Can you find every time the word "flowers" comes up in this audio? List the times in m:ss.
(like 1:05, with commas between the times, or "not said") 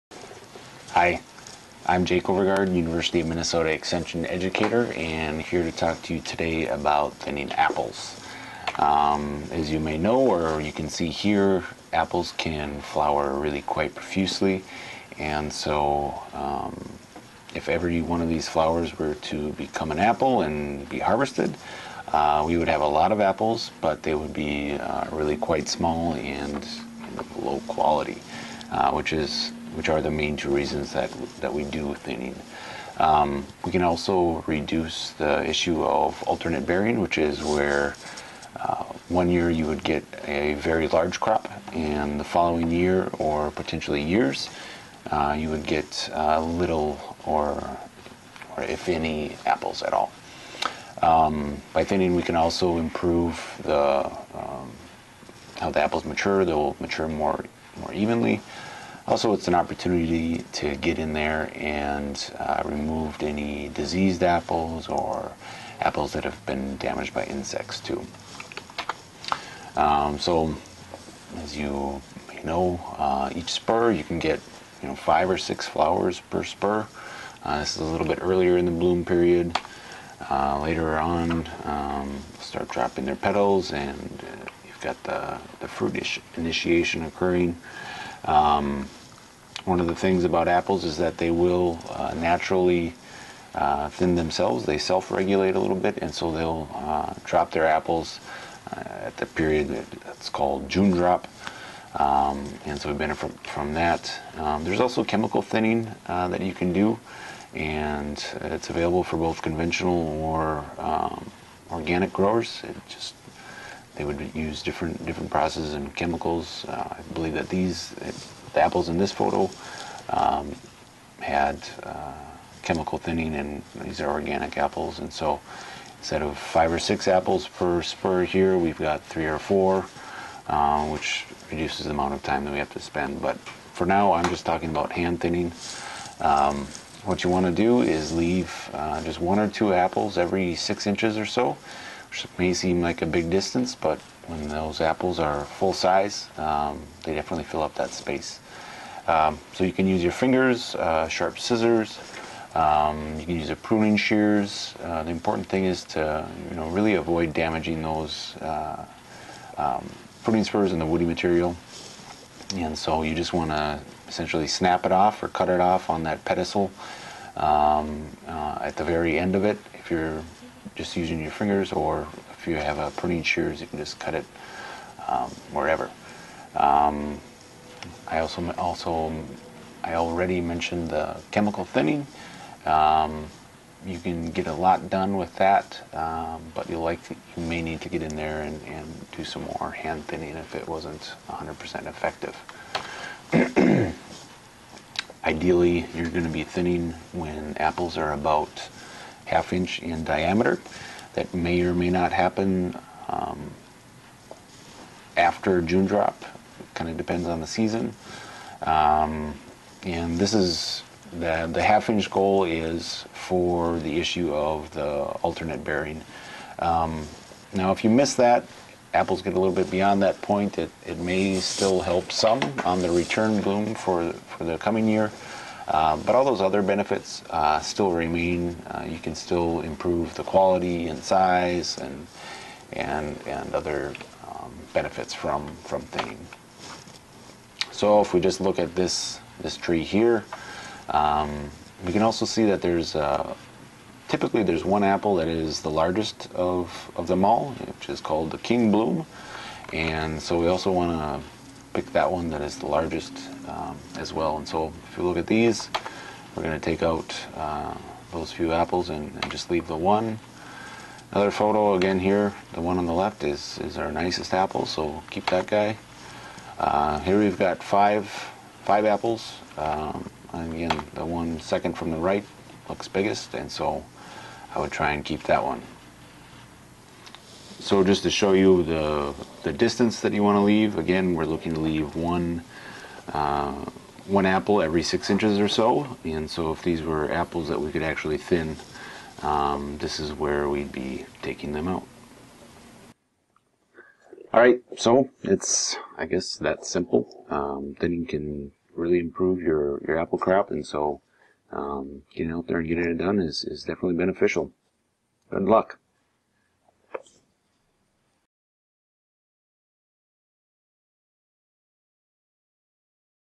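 0:12, 0:18, 1:15.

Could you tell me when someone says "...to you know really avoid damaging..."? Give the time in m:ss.
2:35.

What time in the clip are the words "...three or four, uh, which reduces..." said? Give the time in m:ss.
2:09.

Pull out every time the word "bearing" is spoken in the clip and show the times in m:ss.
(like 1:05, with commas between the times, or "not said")
0:36, 3:35.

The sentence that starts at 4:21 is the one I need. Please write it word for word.
Another photo again here, the one on the left is, is our nicest apple, so keep that guy.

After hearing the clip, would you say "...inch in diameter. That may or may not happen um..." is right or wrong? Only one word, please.
right.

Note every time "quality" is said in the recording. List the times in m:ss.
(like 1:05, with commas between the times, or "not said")
0:27, 3:50.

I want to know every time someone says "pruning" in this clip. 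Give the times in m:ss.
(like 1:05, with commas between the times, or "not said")
2:33, 2:40, 2:52.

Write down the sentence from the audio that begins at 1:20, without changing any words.
Uh, later on, um, start dropping their petals, and uh, you've got the the fruit initiation occurring.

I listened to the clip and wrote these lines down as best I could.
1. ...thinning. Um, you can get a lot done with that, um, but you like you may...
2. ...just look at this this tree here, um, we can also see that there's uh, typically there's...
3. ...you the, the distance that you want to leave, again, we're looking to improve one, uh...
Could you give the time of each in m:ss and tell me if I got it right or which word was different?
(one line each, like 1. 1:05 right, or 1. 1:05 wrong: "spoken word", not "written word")
1. 3:01 right
2. 3:58 right
3. 4:38 wrong: "leave", not "improve".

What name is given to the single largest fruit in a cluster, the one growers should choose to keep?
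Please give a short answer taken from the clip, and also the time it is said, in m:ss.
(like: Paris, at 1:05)
king bloom, at 4:08.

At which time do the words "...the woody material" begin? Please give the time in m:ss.
2:40.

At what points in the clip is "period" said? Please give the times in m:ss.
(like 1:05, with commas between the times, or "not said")
1:19, 1:39.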